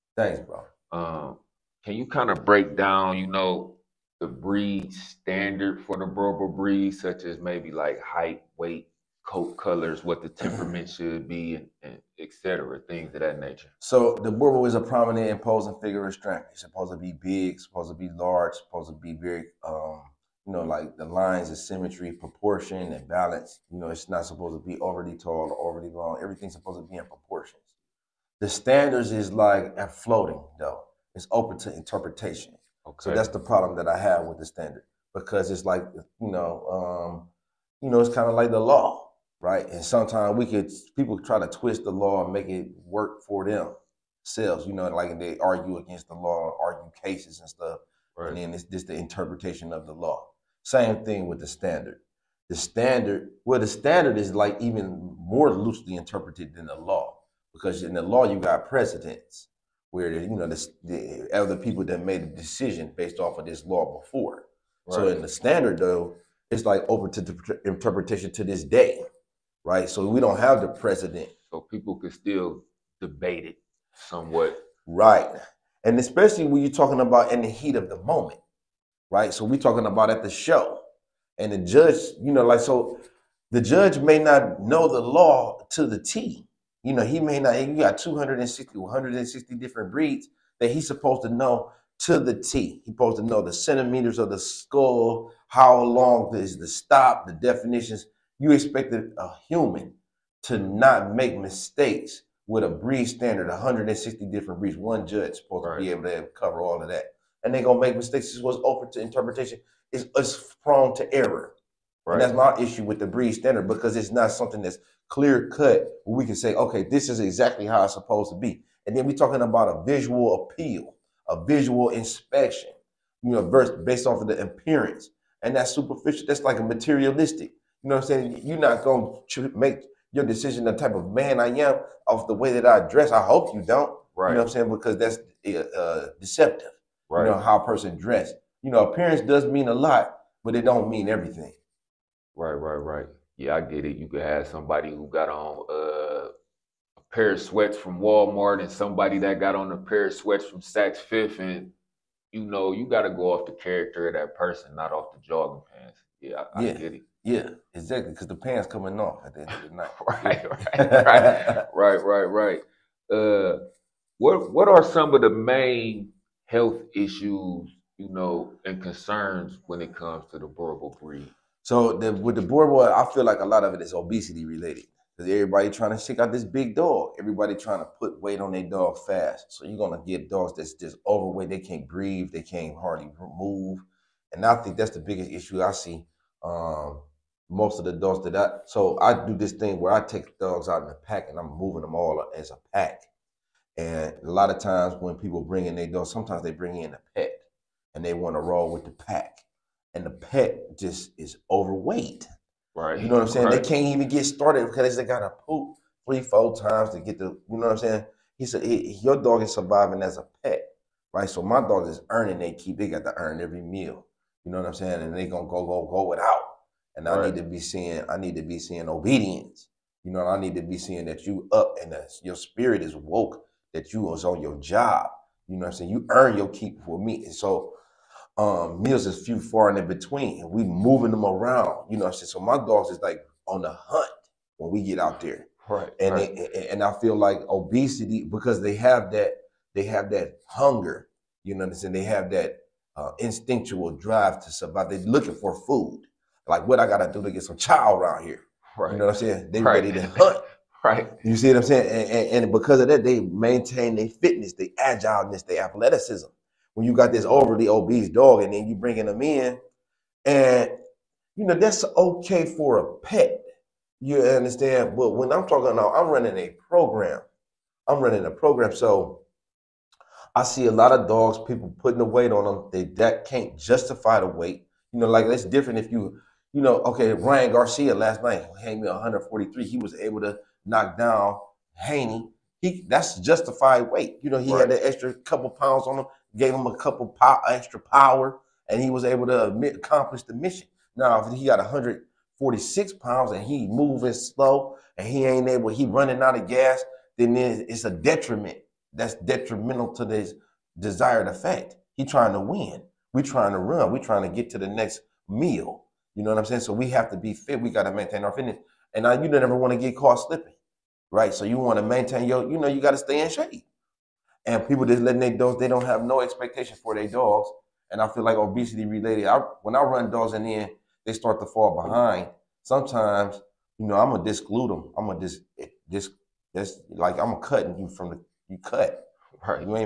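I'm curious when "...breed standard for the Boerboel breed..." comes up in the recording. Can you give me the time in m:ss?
0:04.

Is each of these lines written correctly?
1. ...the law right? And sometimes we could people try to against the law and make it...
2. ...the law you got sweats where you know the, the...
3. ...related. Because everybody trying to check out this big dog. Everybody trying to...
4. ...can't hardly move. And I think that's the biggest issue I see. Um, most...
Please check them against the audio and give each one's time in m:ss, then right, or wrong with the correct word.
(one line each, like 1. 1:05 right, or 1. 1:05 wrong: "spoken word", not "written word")
1. 0:38 wrong: "twist", not "against"
2. 0:57 wrong: "precedents", not "sweats"
3. 2:54 right
4. 3:02 right.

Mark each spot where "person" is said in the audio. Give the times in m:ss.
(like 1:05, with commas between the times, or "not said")
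2:17, 2:34.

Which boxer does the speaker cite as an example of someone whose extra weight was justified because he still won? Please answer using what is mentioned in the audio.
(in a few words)
Ryan Garcia.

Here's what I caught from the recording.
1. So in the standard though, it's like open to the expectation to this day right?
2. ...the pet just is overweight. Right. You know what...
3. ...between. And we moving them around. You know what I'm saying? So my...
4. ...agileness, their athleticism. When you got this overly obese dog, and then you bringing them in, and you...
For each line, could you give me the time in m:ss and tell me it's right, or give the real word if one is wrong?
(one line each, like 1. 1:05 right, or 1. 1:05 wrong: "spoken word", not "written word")
1. 1:04 wrong: "interpretation", not "expectation"
2. 3:20 right
3. 3:49 right
4. 4:14 right.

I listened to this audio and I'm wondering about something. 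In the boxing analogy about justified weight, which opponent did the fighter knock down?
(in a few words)
Haney.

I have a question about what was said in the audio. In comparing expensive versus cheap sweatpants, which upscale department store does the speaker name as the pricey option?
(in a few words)
Saks Fifth.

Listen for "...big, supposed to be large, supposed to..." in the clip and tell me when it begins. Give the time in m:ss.
0:17.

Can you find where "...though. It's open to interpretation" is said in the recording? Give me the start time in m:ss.
0:30.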